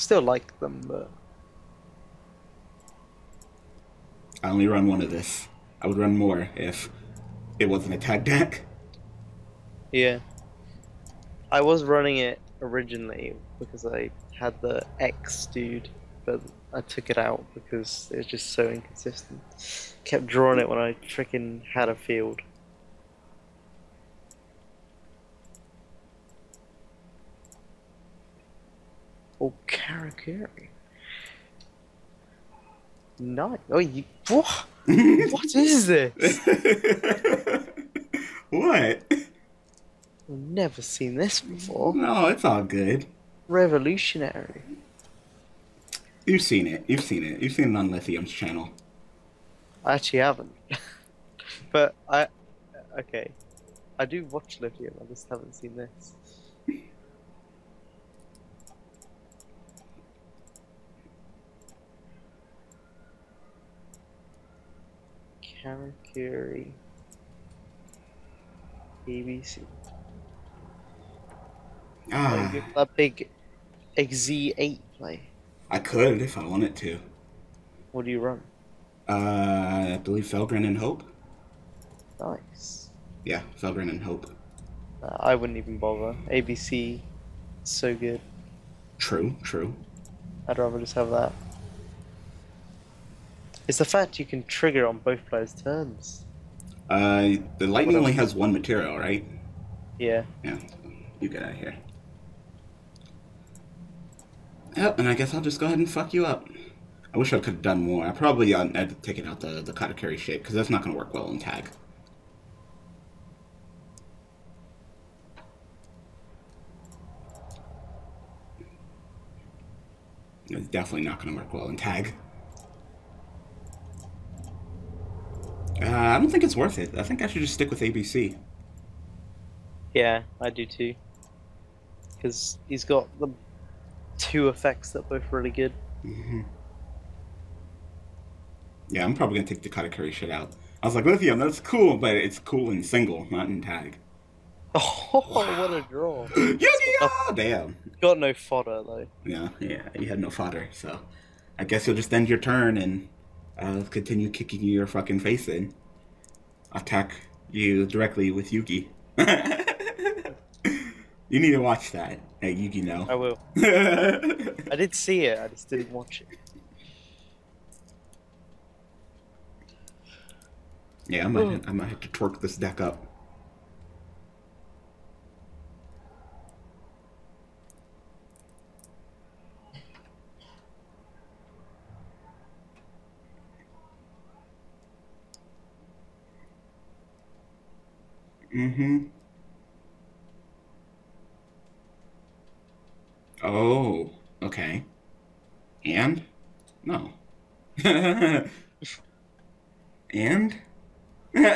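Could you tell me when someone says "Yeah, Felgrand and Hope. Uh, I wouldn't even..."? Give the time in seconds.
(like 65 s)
83 s.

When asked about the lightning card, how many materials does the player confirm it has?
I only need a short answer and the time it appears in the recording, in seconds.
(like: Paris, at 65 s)
1, at 98 s.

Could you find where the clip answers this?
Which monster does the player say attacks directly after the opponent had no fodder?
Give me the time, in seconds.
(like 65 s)
158 s.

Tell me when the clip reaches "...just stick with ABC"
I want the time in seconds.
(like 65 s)
127 s.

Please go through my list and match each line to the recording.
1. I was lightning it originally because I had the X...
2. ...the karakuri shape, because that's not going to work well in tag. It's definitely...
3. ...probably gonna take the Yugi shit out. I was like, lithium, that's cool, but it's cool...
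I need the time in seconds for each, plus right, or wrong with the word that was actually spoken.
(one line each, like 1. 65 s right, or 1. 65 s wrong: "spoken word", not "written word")
1. 11 s wrong: "running", not "lightning"
2. 109 s right
3. 139 s wrong: "Karakuri", not "Yugi".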